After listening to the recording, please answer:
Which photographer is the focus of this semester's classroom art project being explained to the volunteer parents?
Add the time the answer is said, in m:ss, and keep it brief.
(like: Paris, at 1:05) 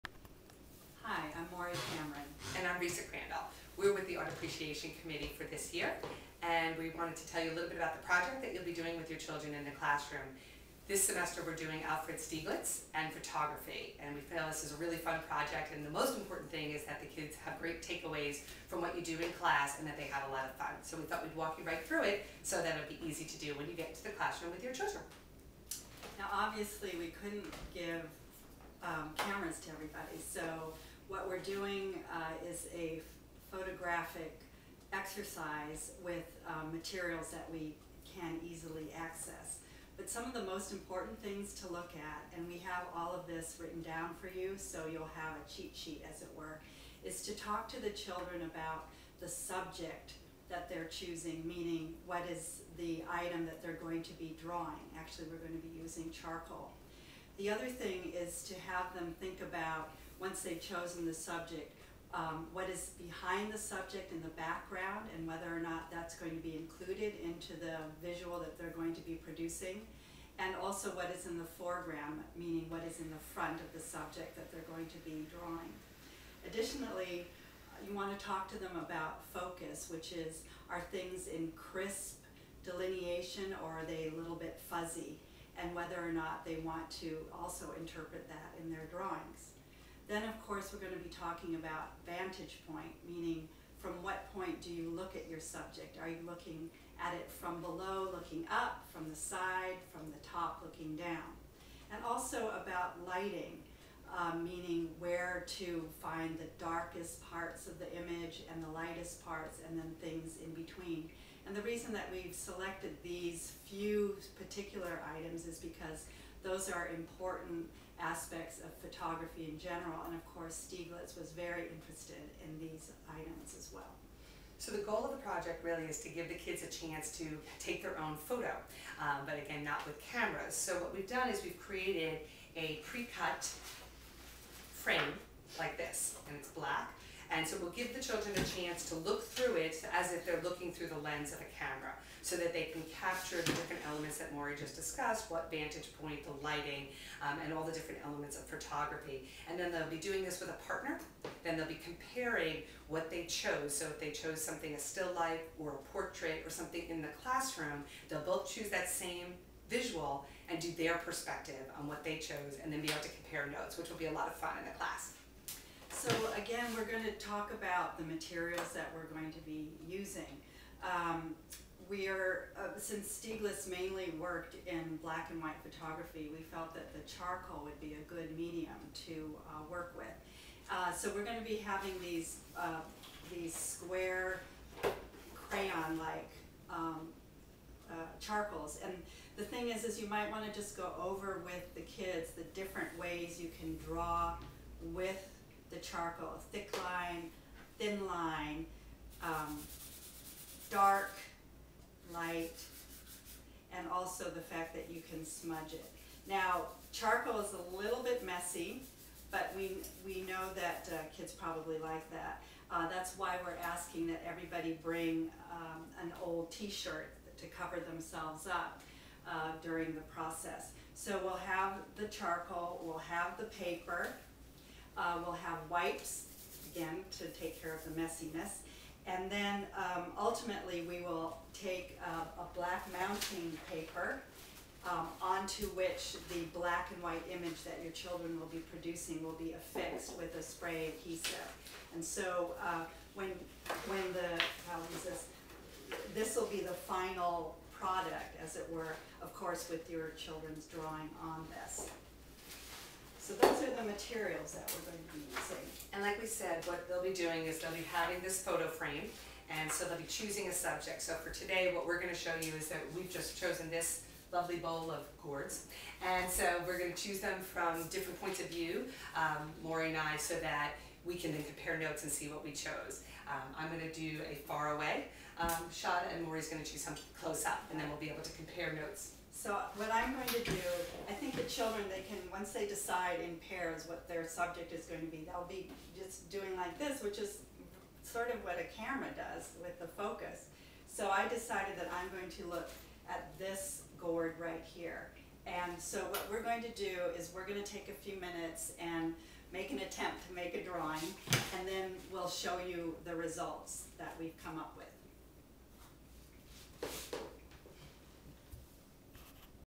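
Alfred Stieglitz, at 0:11.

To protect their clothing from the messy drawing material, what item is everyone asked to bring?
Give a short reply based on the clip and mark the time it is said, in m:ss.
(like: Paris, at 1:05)
An old t-shirt, at 3:36.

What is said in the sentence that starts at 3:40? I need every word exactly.
So we'll have the charcoal, we'll have the paper, uh, we'll have wipes, again, to take care of the messiness.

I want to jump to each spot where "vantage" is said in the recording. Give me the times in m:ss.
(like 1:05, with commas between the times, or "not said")
1:32, 2:25.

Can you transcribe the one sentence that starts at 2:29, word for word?
And then they'll be doing this with a partner.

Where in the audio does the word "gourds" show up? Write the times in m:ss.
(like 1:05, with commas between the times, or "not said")
4:25, 4:53.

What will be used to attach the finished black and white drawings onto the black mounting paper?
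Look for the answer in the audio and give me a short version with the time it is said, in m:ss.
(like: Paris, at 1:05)
Spray adhesive, at 4:00.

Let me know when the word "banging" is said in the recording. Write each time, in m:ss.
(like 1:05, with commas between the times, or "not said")
not said.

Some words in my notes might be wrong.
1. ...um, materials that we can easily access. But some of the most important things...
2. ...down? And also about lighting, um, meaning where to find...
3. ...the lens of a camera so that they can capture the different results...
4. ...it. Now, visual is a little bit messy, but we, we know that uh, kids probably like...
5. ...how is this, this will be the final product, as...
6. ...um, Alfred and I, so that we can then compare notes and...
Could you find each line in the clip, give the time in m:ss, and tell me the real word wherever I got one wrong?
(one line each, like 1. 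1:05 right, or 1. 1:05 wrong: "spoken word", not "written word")
1. 0:36 right
2. 1:40 right
3. 2:20 wrong: "elements", not "results"
4. 3:25 wrong: "charcoal", not "visual"
5. 4:04 right
6. 4:29 wrong: "Lori", not "Alfred".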